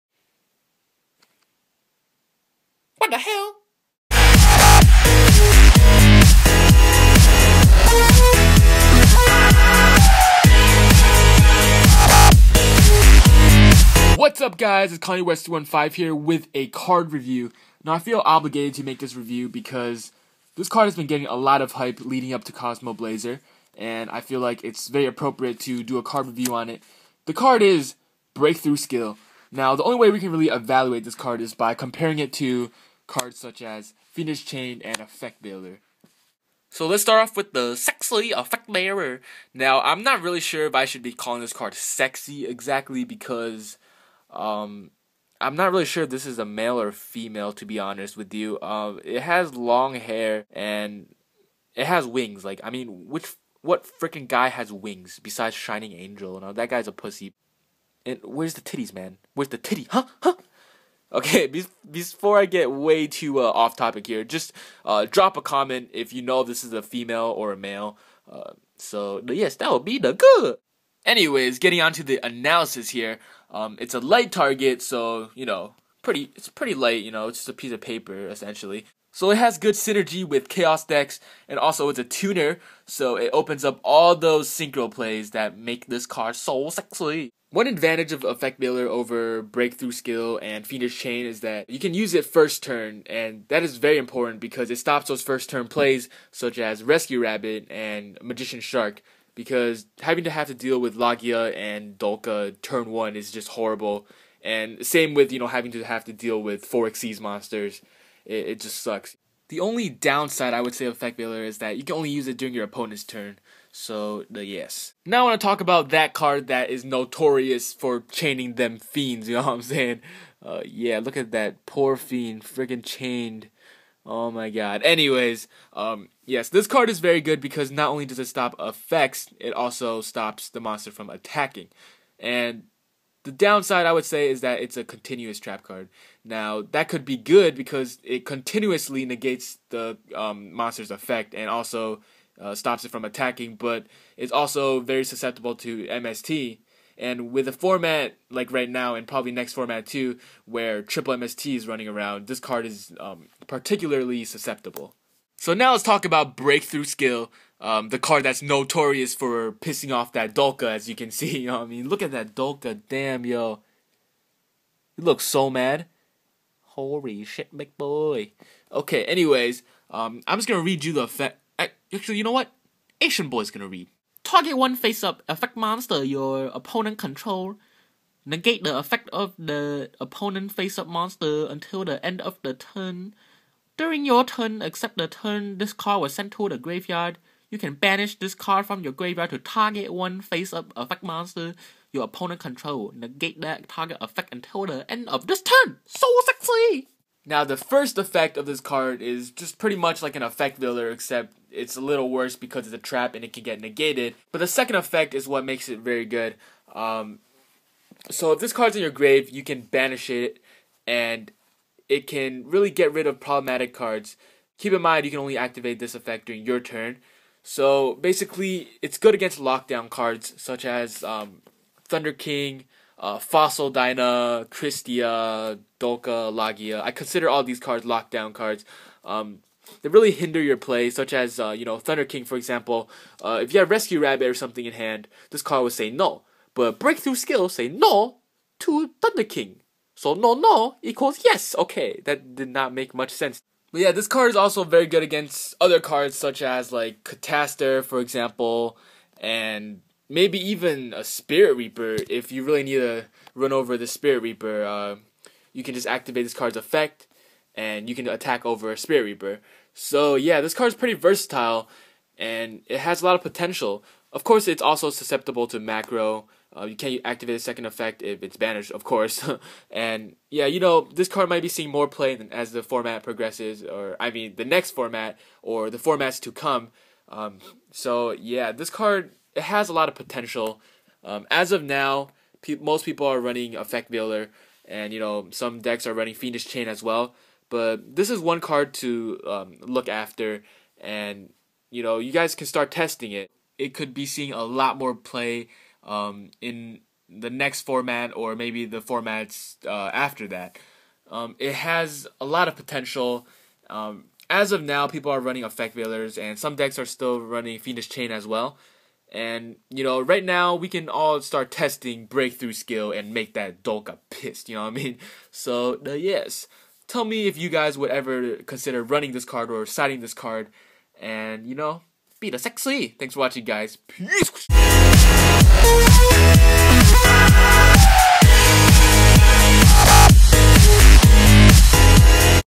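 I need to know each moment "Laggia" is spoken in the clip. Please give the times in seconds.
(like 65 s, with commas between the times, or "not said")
100 s, 226 s.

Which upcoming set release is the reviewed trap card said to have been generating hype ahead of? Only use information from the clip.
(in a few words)
Cosmo Blazer.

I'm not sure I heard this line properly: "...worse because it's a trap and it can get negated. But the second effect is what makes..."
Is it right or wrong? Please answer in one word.
right.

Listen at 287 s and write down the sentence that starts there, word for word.
But this is one card to um, look after, and you know you guys can start testing it.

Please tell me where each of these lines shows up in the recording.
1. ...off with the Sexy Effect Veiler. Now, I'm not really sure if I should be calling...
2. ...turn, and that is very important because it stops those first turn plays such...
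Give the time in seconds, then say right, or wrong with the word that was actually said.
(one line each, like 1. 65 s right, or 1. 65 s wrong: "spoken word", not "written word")
1. 37 s right
2. 92 s right.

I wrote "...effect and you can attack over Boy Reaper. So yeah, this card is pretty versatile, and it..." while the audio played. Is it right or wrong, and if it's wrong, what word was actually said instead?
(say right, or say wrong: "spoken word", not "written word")
wrong: "Spirit", not "Boy".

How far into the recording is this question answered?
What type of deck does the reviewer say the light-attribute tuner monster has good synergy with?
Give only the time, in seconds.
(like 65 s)
80 s.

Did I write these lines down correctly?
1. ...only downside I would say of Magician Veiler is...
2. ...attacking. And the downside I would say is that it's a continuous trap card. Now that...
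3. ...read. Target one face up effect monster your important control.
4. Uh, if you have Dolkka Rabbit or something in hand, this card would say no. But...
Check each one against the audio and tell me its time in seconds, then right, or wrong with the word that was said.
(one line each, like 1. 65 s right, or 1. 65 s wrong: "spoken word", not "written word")
1. 109 s wrong: "Effect", not "Magician"
2. 131 s right
3. 173 s wrong: "opponent", not "important"
4. 233 s wrong: "Rescue", not "Dolkka".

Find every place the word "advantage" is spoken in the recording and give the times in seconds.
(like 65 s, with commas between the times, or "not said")
87 s.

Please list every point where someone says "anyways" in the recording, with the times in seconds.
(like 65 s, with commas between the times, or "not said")
71 s, 124 s, 169 s.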